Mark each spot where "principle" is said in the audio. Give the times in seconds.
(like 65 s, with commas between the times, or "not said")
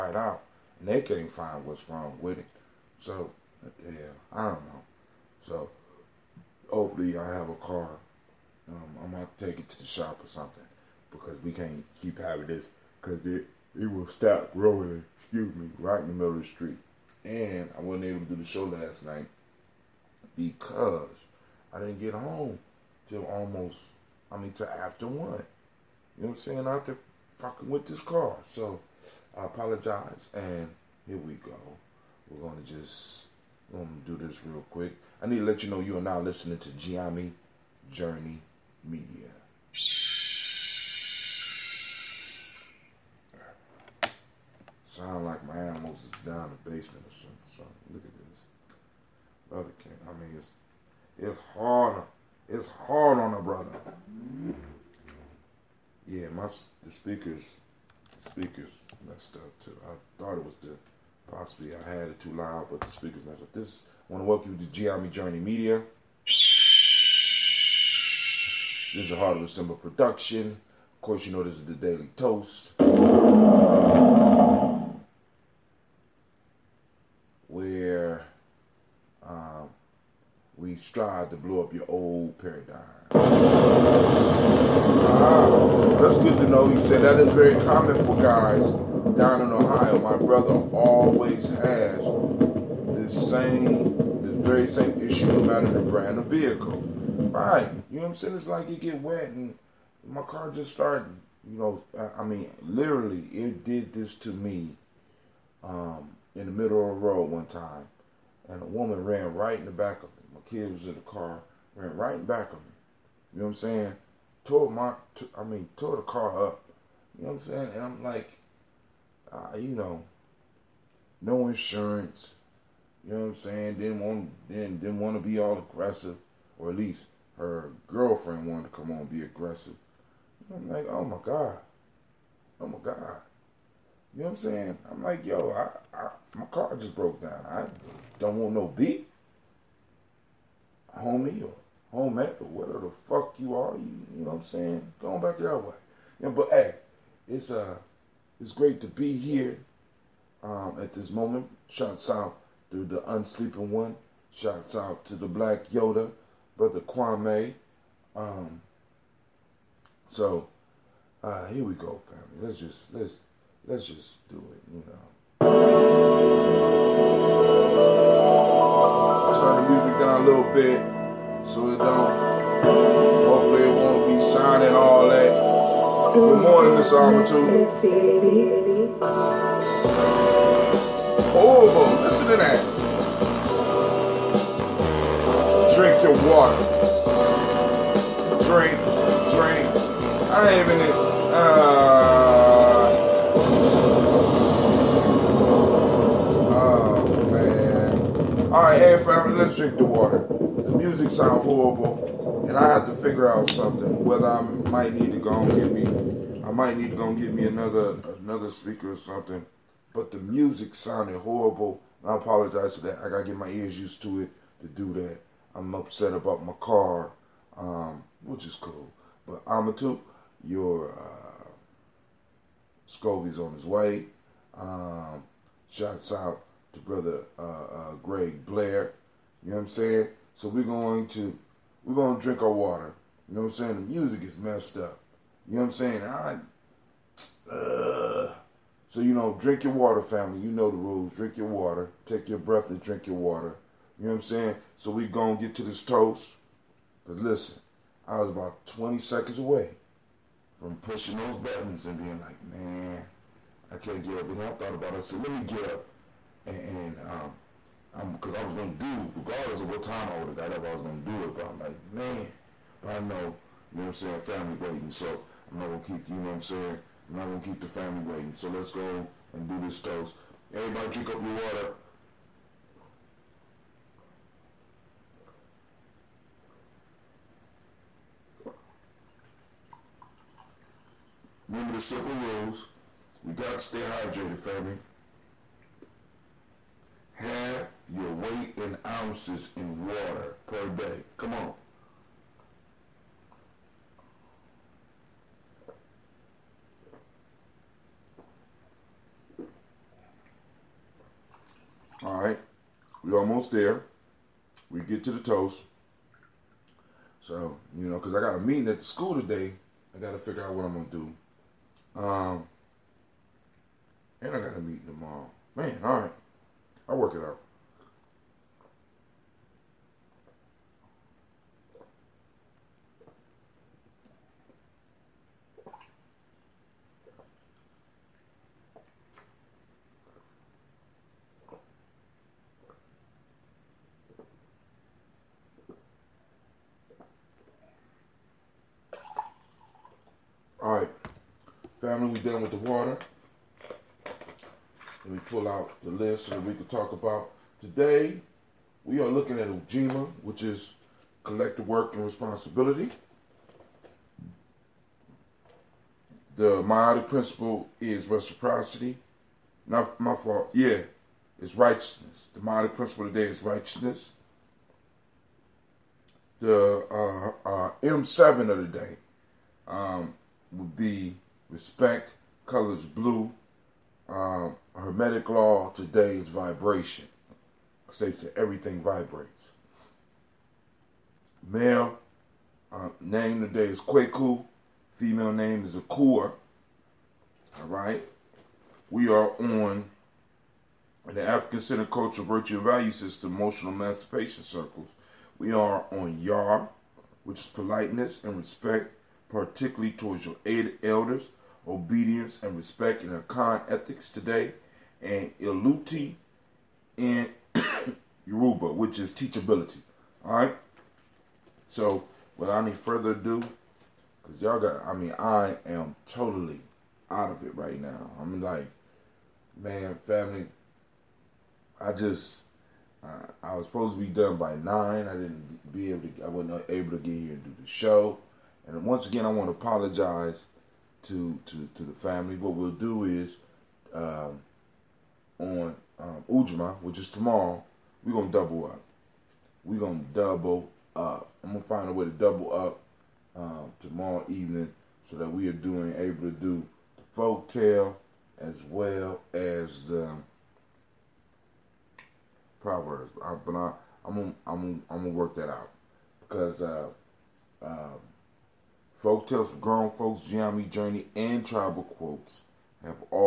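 357 s, 362 s.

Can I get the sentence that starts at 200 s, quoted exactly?
The music sound horrible, and I have to figure out something.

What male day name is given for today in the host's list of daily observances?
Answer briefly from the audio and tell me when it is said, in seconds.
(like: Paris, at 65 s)
Kwaku, at 383 s.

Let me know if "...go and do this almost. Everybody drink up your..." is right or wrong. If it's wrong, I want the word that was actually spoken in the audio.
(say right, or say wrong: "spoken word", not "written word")
wrong: "toast", not "almost".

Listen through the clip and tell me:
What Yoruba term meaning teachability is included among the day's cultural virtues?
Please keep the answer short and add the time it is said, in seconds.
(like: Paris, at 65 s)
Iluti, at 405 s.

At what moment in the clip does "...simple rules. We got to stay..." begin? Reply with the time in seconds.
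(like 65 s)
281 s.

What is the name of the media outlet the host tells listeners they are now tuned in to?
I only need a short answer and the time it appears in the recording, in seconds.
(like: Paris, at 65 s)
Gye-Nyame Journey Media, at 36 s.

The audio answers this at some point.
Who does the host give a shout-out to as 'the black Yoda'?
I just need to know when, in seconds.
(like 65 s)
156 s.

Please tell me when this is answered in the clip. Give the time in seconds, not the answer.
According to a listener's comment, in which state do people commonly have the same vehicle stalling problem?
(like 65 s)
89 s.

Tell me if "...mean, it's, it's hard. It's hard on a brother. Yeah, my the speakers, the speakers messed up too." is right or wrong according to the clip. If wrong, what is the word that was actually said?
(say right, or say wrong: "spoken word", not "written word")
right.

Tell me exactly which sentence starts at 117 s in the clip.
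And I'm like, uh, you know, no insurance.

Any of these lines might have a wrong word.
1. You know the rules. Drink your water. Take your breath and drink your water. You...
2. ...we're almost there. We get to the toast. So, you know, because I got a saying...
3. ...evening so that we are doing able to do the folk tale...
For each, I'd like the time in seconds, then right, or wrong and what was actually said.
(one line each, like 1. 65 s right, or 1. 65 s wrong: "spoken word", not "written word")
1. 240 s right
2. 303 s wrong: "meeting", not "saying"
3. 444 s right.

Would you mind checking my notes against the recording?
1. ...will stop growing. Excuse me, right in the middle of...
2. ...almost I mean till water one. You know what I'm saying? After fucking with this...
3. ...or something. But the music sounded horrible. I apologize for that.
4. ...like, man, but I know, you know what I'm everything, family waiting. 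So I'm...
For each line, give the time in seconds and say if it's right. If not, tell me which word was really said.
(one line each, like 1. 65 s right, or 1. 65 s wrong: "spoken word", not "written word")
1. 13 s right
2. 23 s wrong: "after", not "water"
3. 208 s right
4. 261 s wrong: "saying", not "everything".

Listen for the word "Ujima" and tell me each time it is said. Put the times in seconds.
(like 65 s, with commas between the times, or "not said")
349 s, 436 s.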